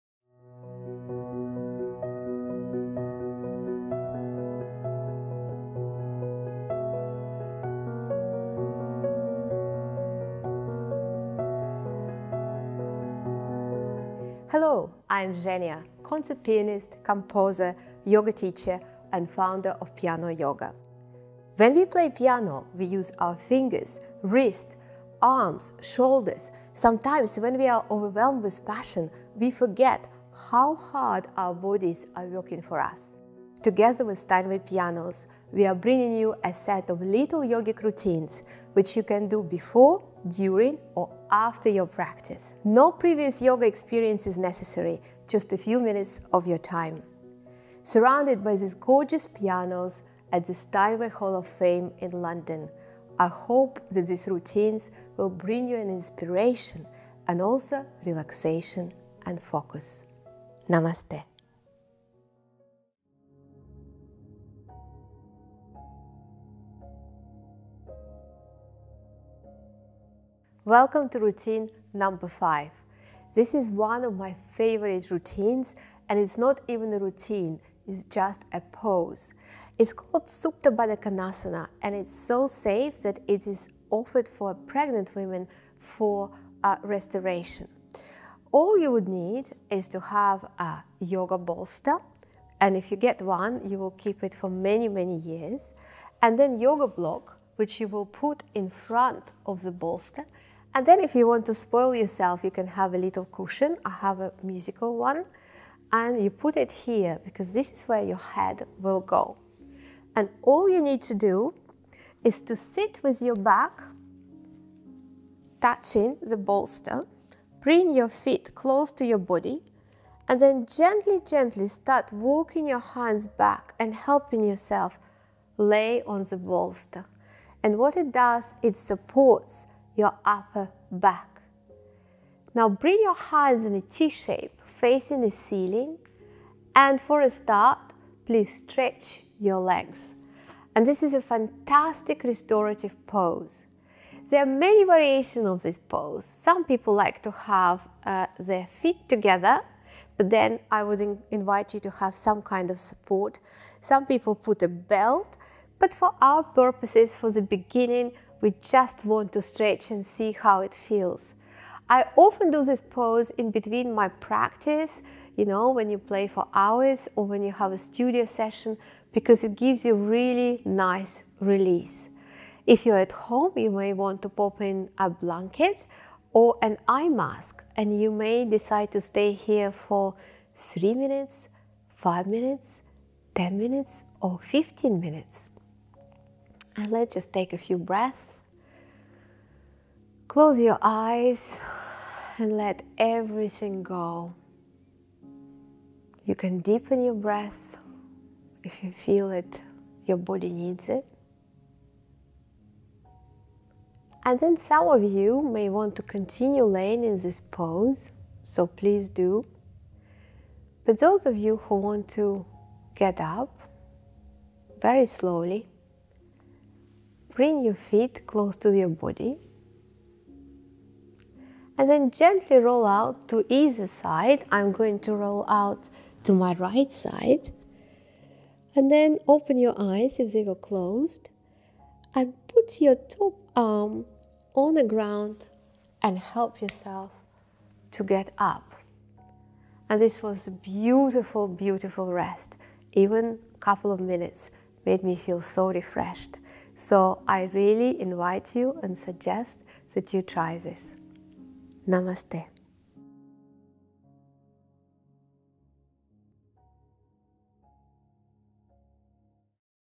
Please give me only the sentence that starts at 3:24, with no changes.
And then some of you may want to continue laying in this pose, so please do.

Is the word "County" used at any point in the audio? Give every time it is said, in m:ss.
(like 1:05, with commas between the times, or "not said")
not said.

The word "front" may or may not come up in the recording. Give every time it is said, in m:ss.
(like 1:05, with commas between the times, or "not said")
1:38.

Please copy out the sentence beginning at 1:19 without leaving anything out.
It's called Supta Baddha Konasana, and it's so safe that it is offered for pregnant women for uh, restoration.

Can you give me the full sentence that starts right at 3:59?
And this was a beautiful, beautiful rest.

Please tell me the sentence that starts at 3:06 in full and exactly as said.
And let's just take a few breaths.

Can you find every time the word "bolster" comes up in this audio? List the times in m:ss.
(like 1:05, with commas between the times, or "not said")
1:31, 1:39, 1:56, 2:06.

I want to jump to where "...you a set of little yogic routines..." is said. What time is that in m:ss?
0:36.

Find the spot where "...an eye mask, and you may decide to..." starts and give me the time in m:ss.
2:56.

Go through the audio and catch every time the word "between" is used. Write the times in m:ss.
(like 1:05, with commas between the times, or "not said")
2:43.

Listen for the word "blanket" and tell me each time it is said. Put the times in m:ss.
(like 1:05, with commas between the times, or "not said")
2:55.